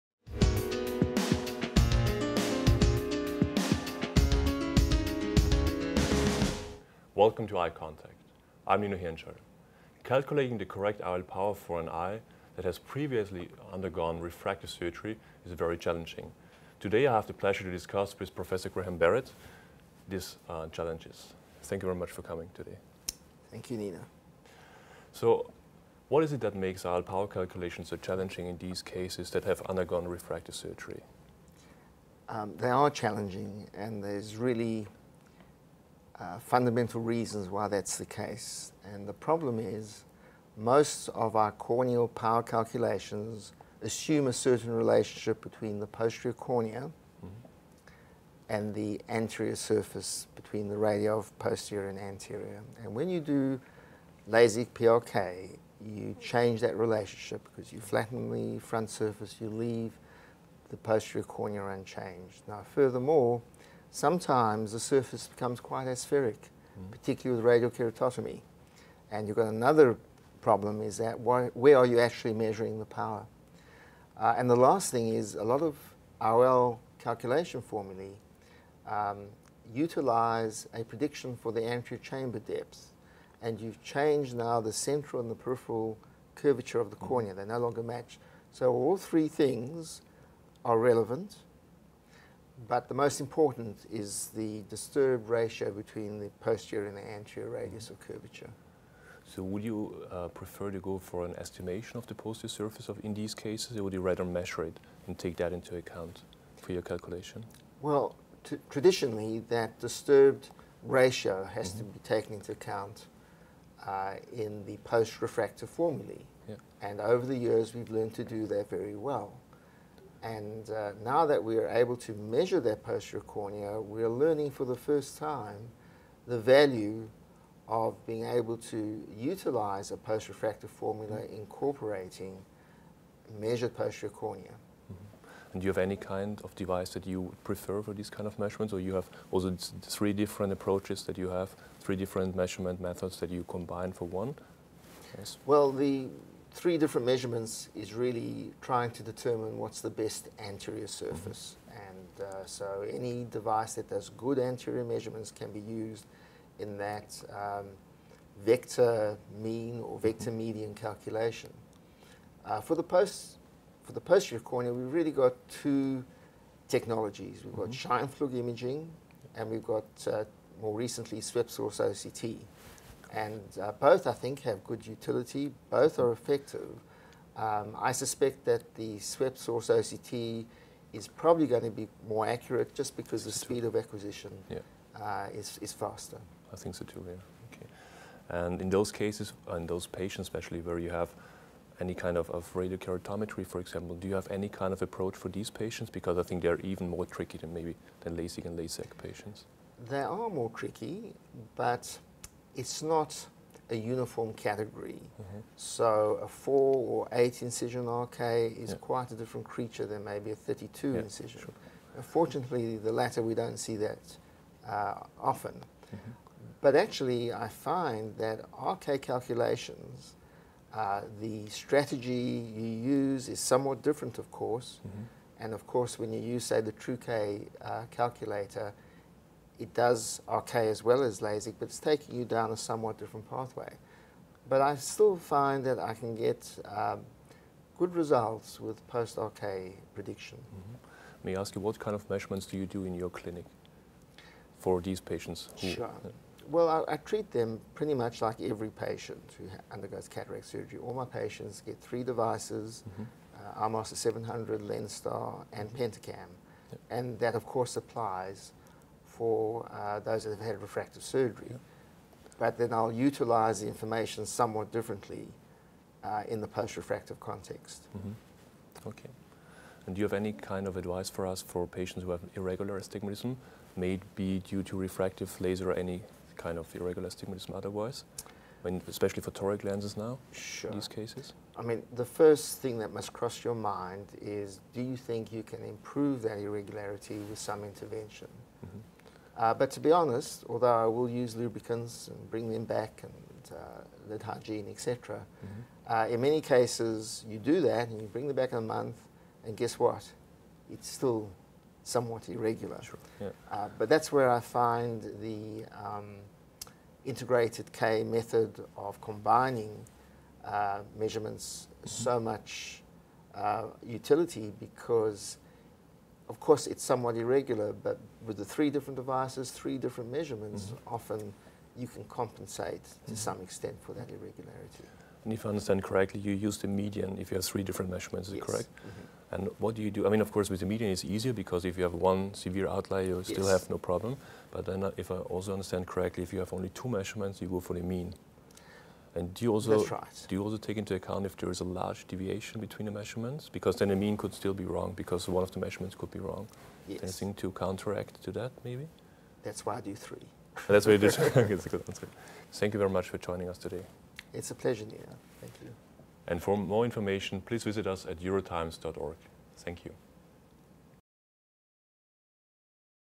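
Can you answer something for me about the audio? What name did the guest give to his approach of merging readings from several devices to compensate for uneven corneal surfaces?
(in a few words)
integrated K method.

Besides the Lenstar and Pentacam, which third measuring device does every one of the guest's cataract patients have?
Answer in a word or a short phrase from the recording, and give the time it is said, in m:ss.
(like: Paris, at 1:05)
AMOS 700, at 4:13.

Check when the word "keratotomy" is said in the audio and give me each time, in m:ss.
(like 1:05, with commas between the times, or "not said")
1:07, 3:12.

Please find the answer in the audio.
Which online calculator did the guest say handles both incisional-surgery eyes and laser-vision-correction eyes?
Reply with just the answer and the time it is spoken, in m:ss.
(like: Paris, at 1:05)
TrueK, at 3:46.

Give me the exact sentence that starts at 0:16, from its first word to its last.
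Today I have the pleasure to discuss with Professor Graham Barrett these uh, challenges.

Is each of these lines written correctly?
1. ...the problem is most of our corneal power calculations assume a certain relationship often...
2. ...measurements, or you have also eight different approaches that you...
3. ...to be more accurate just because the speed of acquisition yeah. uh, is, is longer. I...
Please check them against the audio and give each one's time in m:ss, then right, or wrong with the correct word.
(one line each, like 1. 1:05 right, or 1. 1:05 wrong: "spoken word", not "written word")
1. 0:39 wrong: "between", not "often"
2. 2:18 wrong: "three", not "eight"
3. 3:01 wrong: "faster", not "longer".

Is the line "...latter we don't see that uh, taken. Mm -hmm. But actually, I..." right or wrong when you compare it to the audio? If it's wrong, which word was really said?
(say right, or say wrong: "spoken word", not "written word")
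wrong: "often", not "taken".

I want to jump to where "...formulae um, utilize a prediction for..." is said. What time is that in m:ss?
1:17.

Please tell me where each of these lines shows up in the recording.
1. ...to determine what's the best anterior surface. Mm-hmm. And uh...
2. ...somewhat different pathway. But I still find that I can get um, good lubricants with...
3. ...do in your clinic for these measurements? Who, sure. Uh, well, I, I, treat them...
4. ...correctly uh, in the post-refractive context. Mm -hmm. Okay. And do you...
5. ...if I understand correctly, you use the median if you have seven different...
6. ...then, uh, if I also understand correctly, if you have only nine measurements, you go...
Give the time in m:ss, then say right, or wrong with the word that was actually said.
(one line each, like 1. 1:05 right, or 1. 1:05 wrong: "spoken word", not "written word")
1. 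2:28 right
2. 3:52 wrong: "results", not "lubricants"
3. 4:02 wrong: "patients", not "measurements"
4. 4:24 wrong: "differently", not "correctly"
5. 5:25 wrong: "three", not "seven"
6. 5:34 wrong: "two", not "nine".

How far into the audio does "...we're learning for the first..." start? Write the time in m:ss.
2:03.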